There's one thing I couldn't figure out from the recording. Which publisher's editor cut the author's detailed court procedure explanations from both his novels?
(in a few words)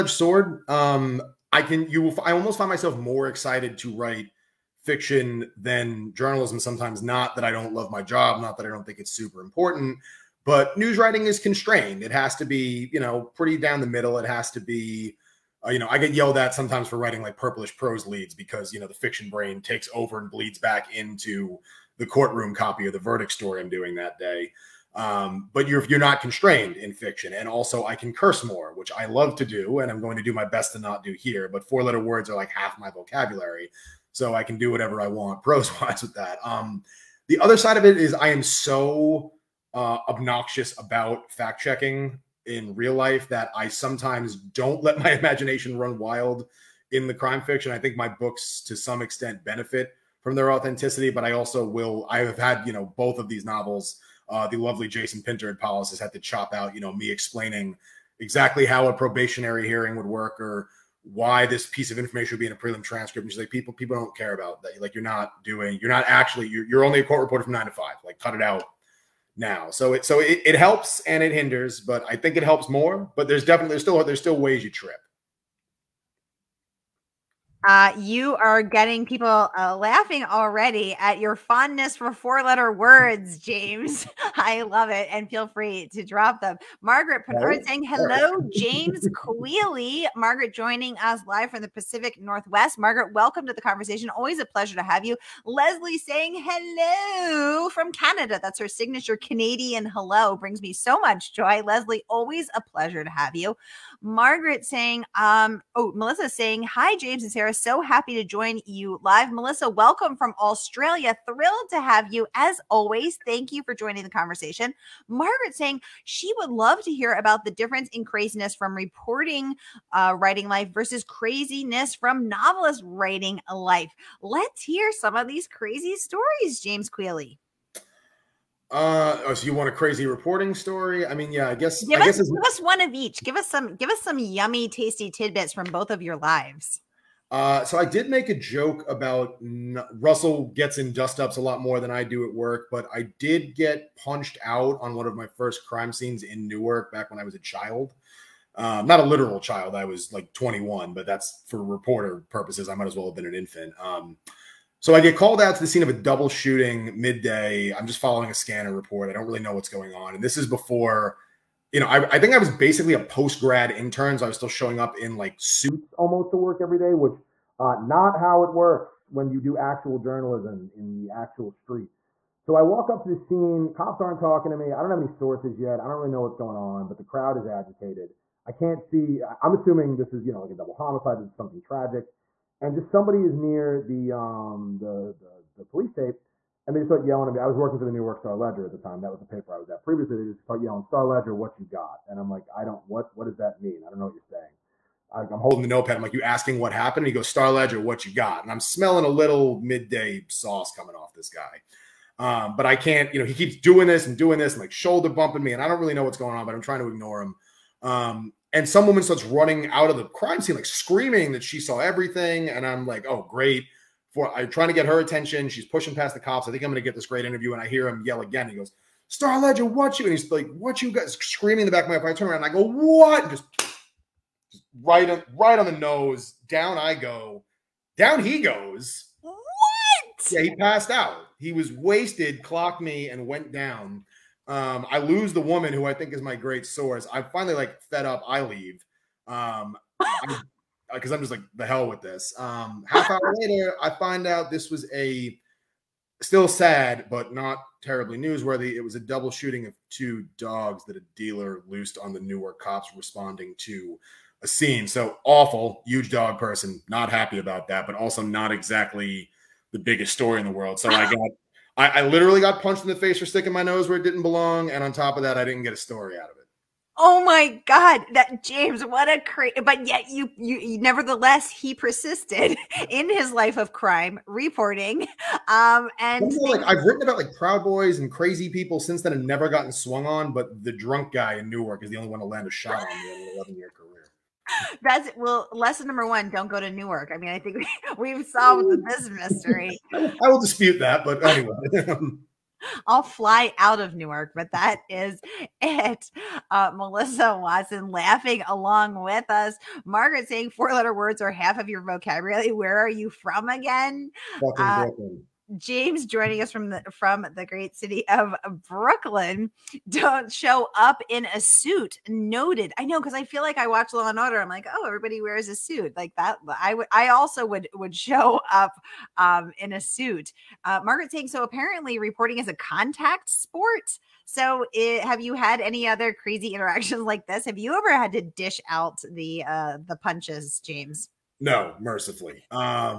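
Polis.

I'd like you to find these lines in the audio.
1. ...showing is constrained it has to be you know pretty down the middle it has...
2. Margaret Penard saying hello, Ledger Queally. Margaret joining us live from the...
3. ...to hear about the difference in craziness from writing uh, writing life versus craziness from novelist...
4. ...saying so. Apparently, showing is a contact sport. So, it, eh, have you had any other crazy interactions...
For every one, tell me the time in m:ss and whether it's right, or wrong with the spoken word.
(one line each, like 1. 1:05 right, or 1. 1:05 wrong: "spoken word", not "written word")
1. 0:10 wrong: "writing", not "showing"
2. 1:26 wrong: "James", not "Ledger"
3. 1:56 wrong: "reporting", not "writing"
4. 5:21 wrong: "reporting", not "showing".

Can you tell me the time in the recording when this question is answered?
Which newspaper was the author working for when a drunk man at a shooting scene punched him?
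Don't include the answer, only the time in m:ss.
3:07.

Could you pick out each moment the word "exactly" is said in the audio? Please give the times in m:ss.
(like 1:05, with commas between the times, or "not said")
0:58, 4:18.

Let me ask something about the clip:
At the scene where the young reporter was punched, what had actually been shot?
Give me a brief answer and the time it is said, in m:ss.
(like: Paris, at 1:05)
Two dogs, at 4:09.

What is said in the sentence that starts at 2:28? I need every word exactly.
Um, not a literal child, I was like 21, but that's for reporter purposes.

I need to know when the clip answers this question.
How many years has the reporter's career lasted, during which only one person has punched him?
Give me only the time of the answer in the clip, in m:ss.
4:43.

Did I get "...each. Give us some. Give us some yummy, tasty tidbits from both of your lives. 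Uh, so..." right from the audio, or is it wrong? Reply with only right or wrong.
right.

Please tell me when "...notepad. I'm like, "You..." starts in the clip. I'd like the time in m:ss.
3:15.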